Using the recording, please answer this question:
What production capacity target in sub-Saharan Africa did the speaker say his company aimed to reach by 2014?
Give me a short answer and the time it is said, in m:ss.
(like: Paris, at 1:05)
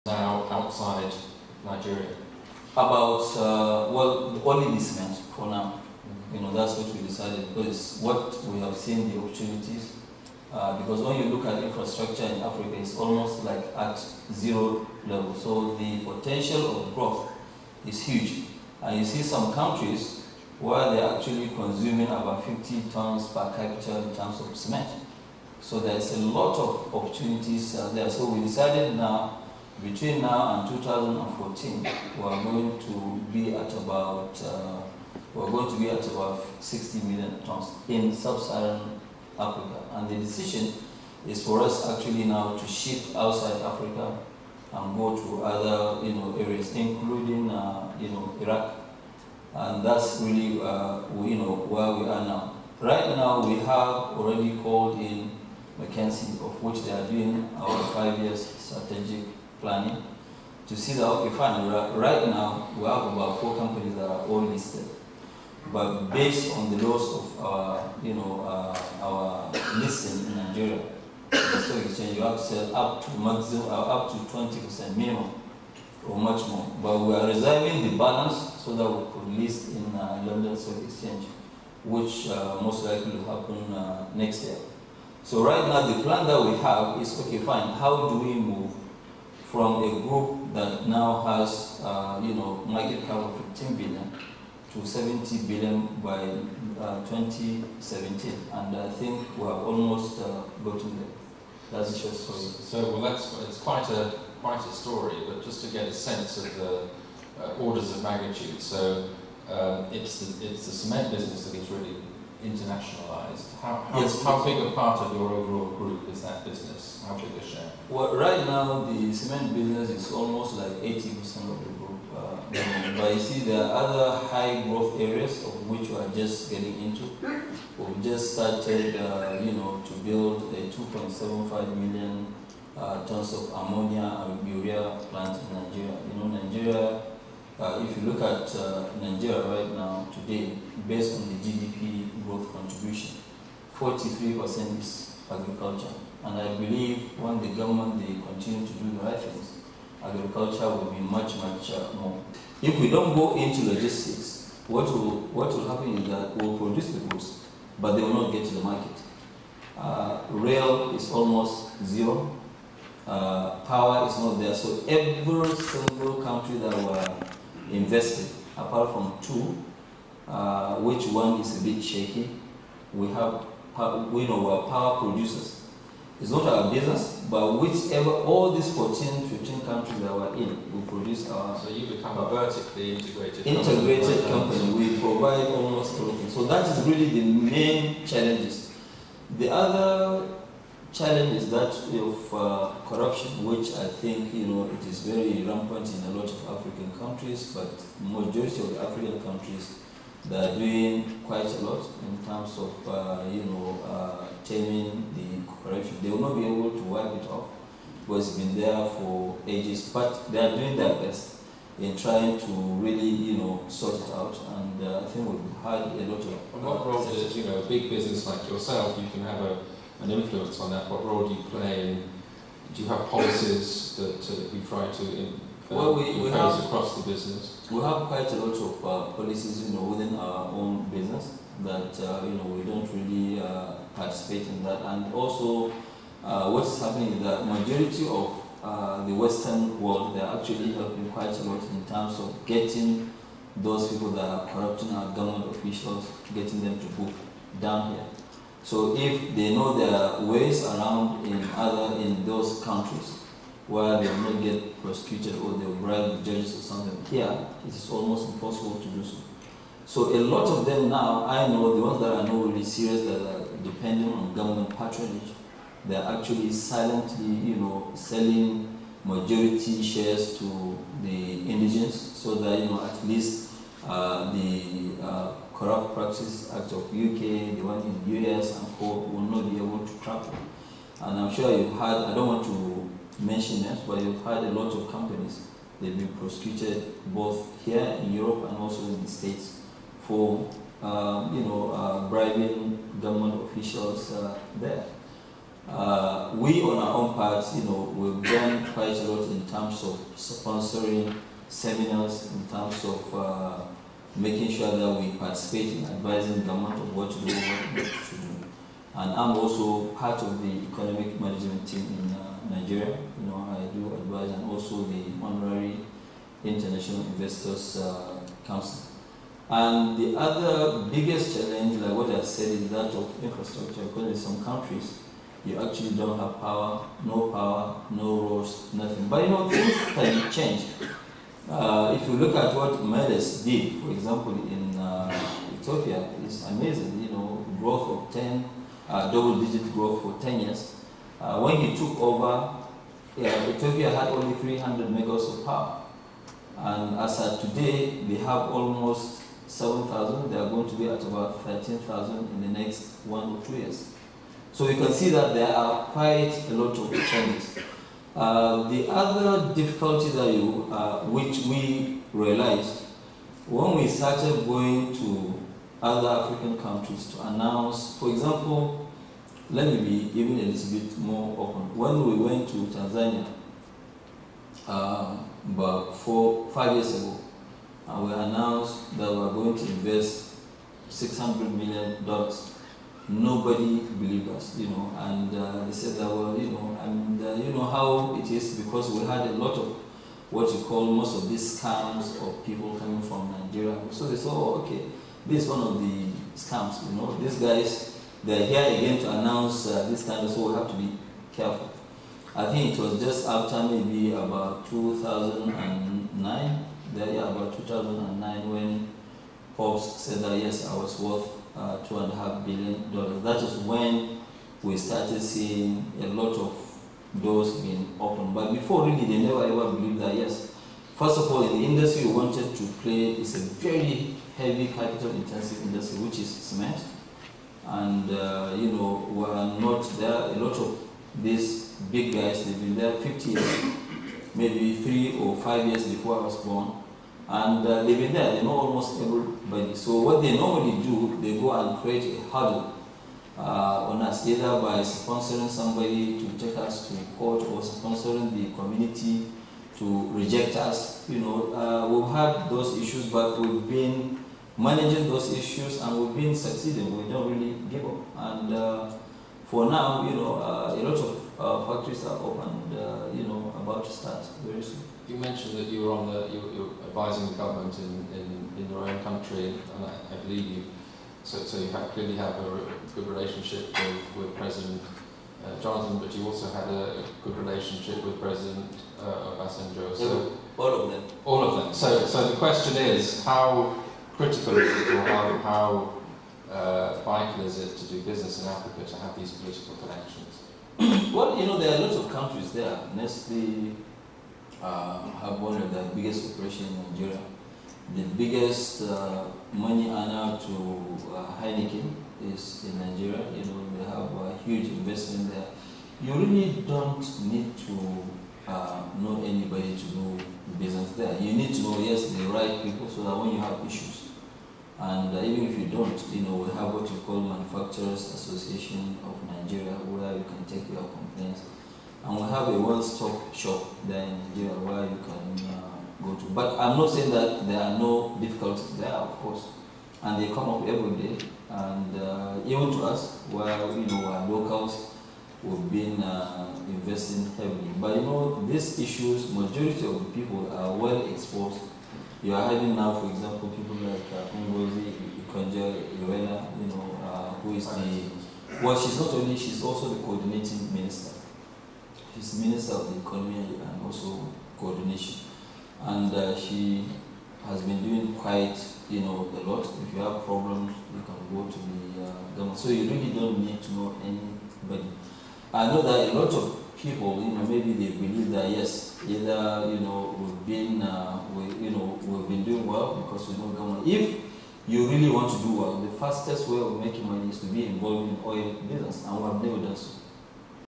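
60 million tons, at 0:36.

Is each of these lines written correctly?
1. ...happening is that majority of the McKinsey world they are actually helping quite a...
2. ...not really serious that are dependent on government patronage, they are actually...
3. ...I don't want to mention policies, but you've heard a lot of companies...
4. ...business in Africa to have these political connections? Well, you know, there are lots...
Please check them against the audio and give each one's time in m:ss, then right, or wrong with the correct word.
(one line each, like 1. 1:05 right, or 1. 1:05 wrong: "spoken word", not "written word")
1. 3:56 wrong: "Western", not "McKinsey"
2. 4:22 right
3. 4:42 wrong: "names", not "policies"
4. 8:08 right.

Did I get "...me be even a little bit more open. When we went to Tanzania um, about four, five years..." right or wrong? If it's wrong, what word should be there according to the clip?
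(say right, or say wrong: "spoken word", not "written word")
right.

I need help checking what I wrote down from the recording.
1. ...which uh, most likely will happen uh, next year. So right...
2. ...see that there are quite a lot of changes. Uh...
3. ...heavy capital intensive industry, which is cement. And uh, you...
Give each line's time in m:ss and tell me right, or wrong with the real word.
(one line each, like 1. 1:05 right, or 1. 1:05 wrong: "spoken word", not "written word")
1. 1:21 right
2. 5:54 right
3. 7:04 right.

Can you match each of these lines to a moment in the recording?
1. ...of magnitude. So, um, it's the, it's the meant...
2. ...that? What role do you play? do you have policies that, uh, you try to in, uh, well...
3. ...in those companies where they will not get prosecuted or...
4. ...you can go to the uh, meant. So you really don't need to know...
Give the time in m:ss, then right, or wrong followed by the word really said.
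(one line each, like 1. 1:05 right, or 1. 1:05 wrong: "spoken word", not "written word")
1. 1:47 wrong: "cement", not "meant"
2. 3:40 right
3. 4:11 wrong: "countries", not "companies"
4. 9:20 wrong: "government", not "meant".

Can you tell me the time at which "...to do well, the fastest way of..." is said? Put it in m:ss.
9:35.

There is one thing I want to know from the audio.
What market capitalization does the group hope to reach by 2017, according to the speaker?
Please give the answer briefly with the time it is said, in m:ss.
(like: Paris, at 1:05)
70 billion, at 1:34.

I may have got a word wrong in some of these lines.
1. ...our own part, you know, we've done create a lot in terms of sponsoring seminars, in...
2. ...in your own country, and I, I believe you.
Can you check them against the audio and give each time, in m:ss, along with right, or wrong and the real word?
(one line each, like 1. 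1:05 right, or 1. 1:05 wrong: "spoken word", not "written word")
1. 4:56 wrong: "quite", not "create"
2. 7:48 right.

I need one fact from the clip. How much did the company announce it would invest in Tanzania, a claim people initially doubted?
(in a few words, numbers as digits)
$600 million.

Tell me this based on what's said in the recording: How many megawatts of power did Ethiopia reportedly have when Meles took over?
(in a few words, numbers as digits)
300 megawatts.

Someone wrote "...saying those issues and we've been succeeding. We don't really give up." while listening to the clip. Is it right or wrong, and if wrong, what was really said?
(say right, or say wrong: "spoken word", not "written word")
wrong: "managing", not "saying".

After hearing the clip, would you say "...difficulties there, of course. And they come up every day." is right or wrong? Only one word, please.
right.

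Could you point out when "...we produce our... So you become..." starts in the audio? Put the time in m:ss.
3:00.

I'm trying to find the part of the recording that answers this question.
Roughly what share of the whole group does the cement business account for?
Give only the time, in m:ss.
2:00.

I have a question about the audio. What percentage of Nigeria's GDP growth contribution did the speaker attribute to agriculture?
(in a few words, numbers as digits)
43%.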